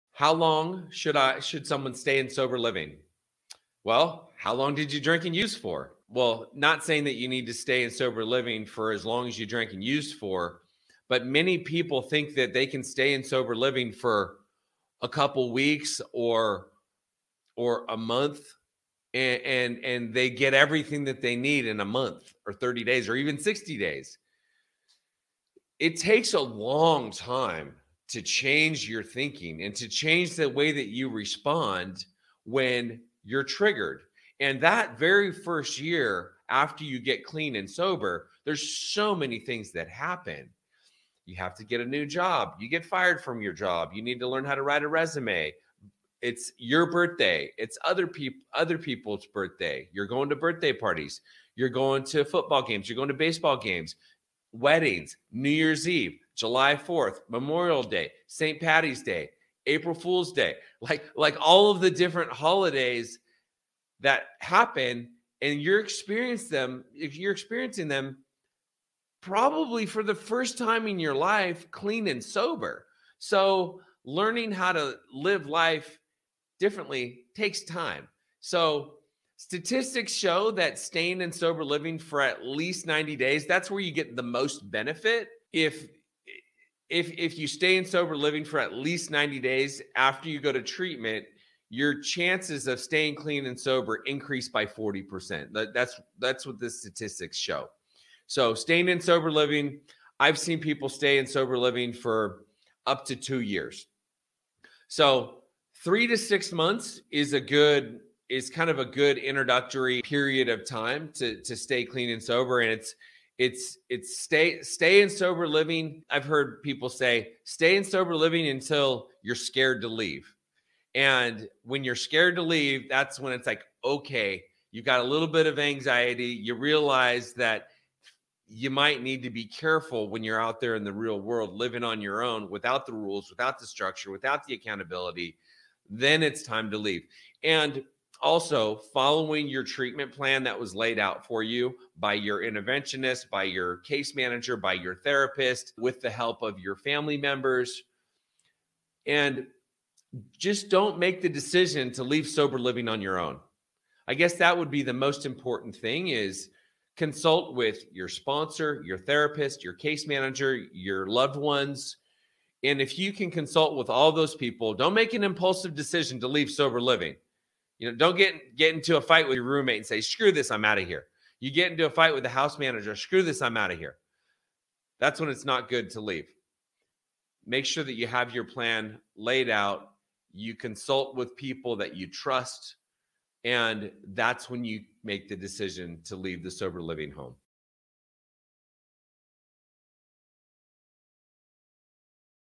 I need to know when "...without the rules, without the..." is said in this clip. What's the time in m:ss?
2:12.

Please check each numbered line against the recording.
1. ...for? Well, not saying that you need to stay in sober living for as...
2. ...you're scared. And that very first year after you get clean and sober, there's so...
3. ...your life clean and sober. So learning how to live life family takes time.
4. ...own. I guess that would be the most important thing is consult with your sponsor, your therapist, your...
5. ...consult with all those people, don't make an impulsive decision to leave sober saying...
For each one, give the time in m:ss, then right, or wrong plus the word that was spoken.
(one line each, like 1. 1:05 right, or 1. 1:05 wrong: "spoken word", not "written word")
1. 0:05 right
2. 0:33 wrong: "triggered", not "scared"
3. 1:10 wrong: "differently", not "family"
4. 2:33 right
5. 2:43 wrong: "living", not "saying".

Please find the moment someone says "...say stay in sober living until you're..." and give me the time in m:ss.
1:56.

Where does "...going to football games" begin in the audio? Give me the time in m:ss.
0:51.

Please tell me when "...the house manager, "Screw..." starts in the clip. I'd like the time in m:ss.
2:52.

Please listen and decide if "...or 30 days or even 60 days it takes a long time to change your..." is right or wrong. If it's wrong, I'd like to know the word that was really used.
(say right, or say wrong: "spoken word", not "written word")
right.